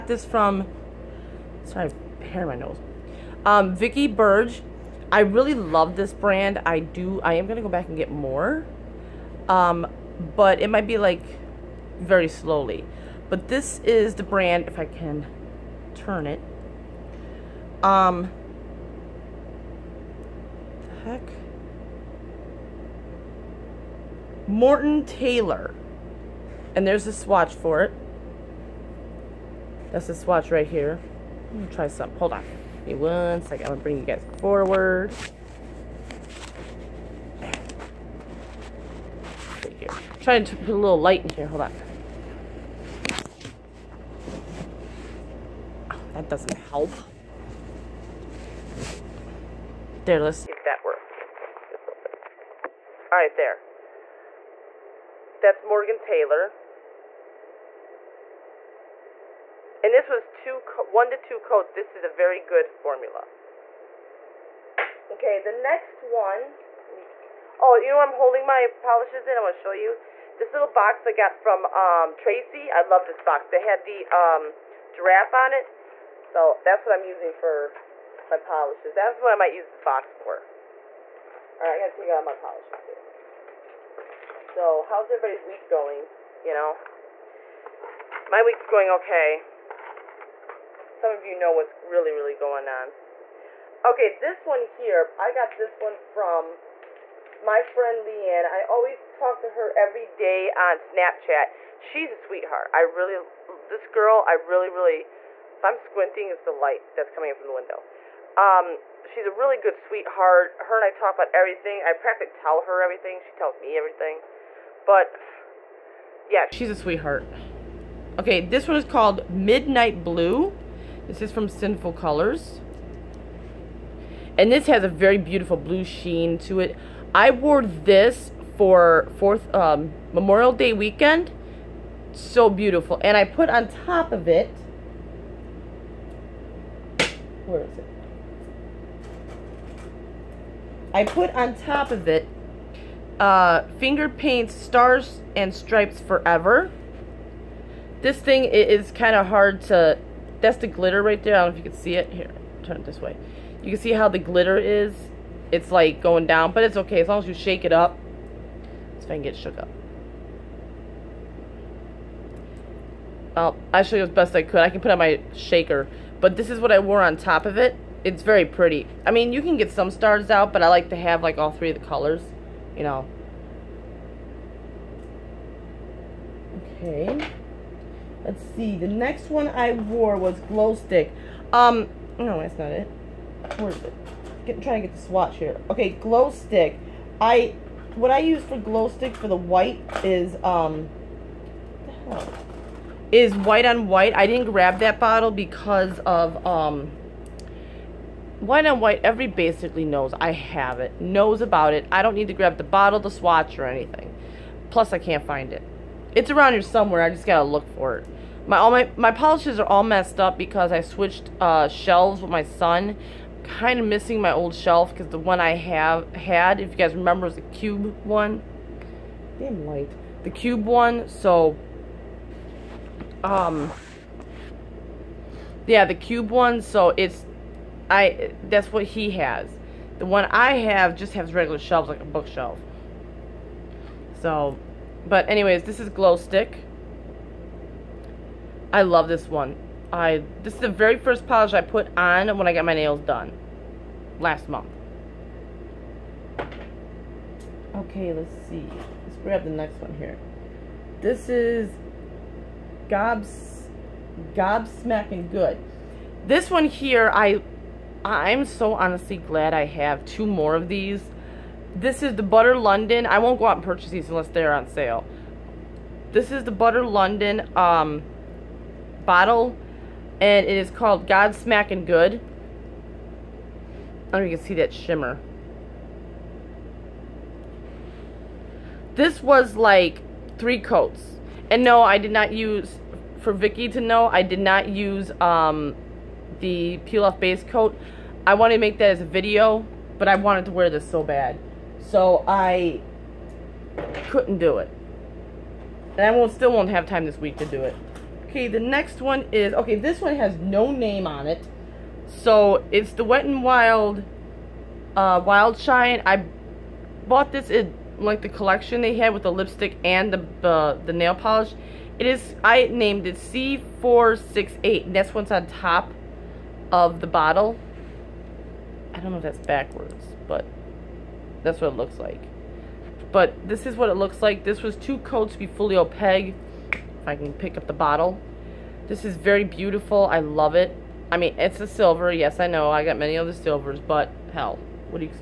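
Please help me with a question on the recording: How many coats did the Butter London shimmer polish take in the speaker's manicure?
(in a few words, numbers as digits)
3.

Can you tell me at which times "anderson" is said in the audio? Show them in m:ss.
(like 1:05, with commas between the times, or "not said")
not said.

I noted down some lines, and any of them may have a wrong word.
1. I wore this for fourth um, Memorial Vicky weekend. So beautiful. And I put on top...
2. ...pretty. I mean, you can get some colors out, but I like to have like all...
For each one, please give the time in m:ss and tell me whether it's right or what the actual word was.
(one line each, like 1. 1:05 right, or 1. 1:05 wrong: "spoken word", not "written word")
1. 2:07 wrong: "Day", not "Vicky"
2. 2:48 wrong: "stars", not "colors".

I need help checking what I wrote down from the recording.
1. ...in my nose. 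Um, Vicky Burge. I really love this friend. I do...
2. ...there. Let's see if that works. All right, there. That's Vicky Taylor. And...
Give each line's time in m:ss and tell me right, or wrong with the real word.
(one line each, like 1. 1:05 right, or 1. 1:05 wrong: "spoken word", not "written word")
1. 0:02 wrong: "brand", not "friend"
2. 0:50 wrong: "Morgan", not "Vicky".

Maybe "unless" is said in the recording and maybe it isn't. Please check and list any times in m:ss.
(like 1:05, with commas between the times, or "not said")
4:24.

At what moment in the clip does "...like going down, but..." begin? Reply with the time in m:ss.
2:35.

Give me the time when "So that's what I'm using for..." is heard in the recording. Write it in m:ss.
1:16.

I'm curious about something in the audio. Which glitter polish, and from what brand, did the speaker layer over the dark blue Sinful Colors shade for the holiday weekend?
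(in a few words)
Finger Paints Stars and Stripes Forever.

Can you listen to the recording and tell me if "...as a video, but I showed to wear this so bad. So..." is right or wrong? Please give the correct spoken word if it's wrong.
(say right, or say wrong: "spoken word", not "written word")
wrong: "wanted", not "showed".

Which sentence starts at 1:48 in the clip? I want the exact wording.
Um, she's a really good sweetheart.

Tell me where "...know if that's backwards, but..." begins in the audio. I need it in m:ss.
5:19.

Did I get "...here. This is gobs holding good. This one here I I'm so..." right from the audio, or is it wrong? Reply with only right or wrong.
wrong.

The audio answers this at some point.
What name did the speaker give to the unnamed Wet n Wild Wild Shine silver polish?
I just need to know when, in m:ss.
5:13.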